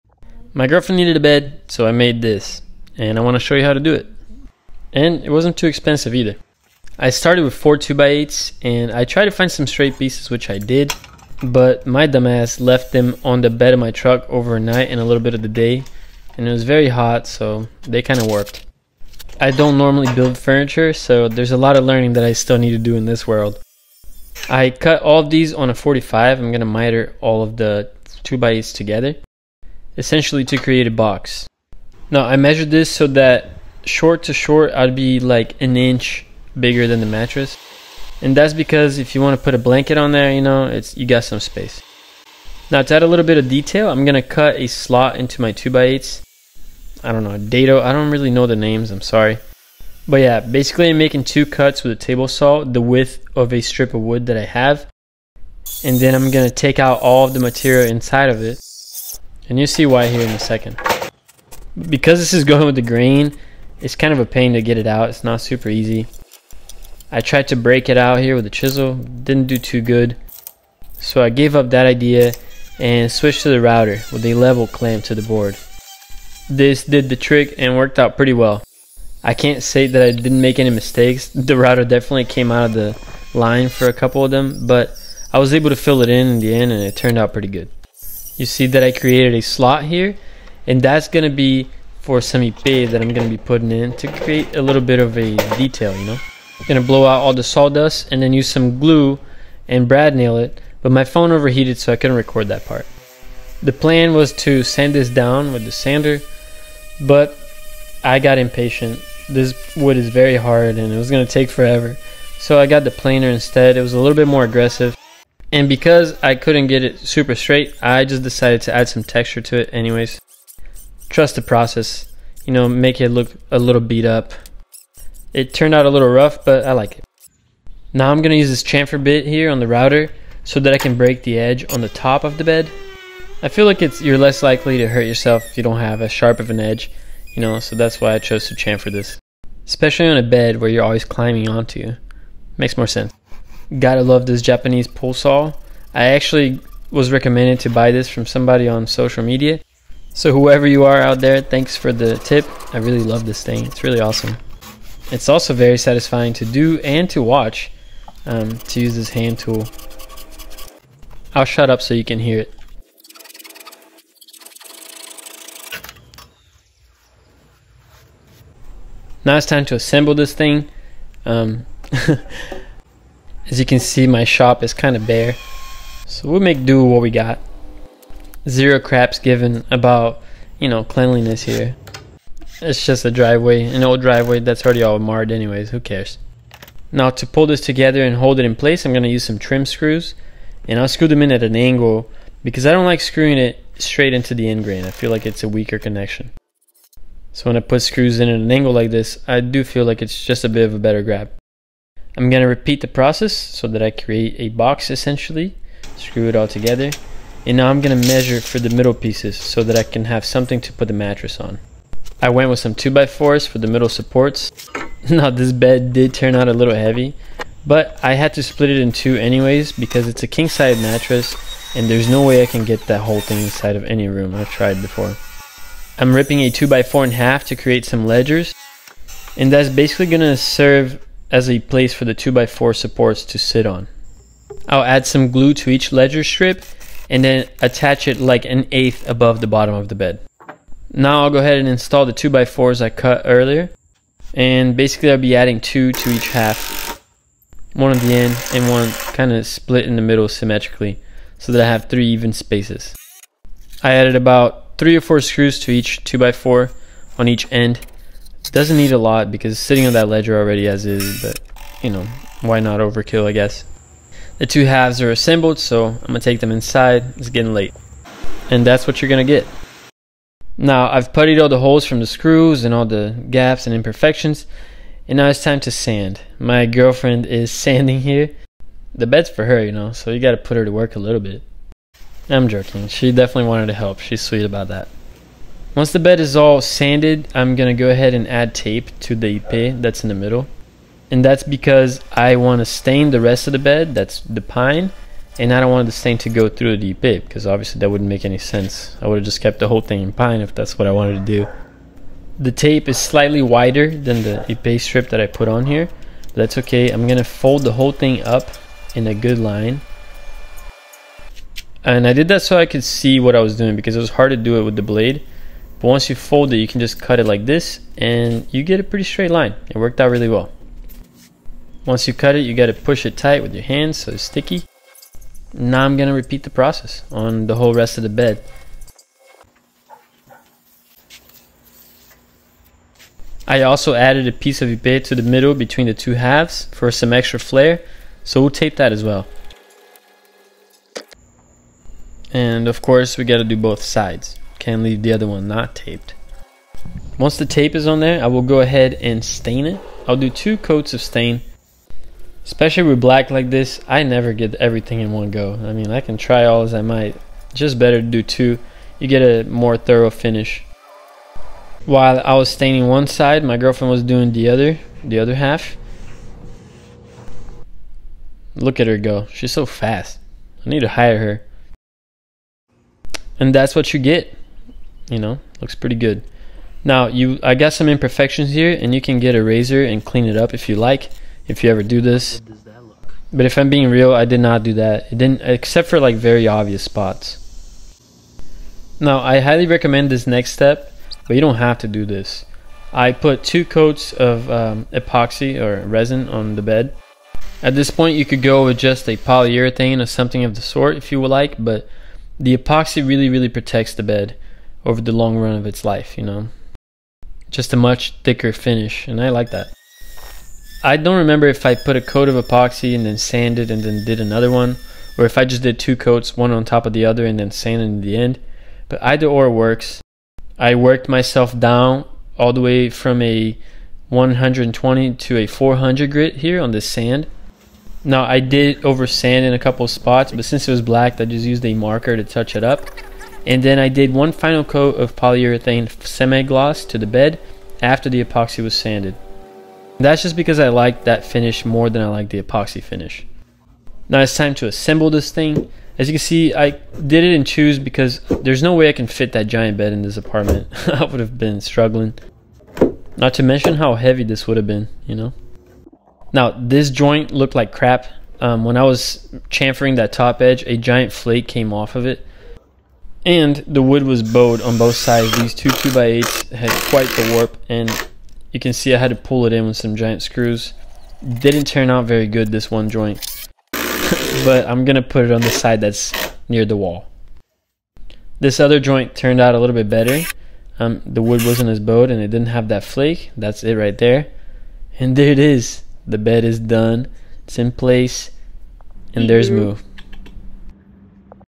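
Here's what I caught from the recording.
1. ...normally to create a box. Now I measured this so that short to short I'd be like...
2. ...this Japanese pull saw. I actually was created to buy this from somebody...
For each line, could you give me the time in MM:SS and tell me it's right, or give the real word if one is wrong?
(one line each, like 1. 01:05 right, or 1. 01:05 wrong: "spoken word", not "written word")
1. 00:30 wrong: "essentially", not "normally"
2. 02:24 wrong: "recommended", not "created".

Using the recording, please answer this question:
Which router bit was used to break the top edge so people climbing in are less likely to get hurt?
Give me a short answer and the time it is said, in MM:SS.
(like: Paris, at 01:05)
Chamfer bit, at 02:08.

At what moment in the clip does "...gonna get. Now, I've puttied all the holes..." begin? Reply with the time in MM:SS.
04:29.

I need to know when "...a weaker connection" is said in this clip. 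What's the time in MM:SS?
03:15.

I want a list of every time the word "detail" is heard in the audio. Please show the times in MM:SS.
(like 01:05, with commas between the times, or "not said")
00:43, 01:35.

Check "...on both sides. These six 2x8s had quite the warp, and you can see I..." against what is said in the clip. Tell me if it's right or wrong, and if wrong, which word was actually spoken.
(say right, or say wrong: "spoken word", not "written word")
wrong: "two", not "six".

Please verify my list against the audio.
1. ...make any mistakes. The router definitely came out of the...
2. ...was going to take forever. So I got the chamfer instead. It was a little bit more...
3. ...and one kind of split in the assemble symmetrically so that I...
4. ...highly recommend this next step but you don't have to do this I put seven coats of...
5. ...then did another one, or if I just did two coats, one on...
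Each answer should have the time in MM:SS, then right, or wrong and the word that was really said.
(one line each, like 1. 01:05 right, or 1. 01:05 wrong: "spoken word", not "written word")
1. 01:20 right
2. 01:50 wrong: "planer", not "chamfer"
3. 04:08 wrong: "middle", not "assemble"
4. 06:29 wrong: "two", not "seven"
5. 06:53 right.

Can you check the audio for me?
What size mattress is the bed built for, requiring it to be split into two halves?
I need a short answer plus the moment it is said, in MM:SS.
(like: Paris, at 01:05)
King, at 03:40.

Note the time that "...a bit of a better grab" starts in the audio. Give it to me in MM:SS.
03:20.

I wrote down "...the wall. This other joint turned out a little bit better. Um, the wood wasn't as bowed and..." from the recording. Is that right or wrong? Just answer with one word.
right.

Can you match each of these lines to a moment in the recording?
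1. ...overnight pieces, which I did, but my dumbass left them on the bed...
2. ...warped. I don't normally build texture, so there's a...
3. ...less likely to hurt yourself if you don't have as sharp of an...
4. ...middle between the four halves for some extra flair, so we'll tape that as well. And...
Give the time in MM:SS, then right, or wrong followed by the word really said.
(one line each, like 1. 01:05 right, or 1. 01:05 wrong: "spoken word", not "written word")
1. 00:09 wrong: "straight", not "overnight"
2. 00:18 wrong: "furniture", not "texture"
3. 02:14 right
4. 05:35 wrong: "two", not "four".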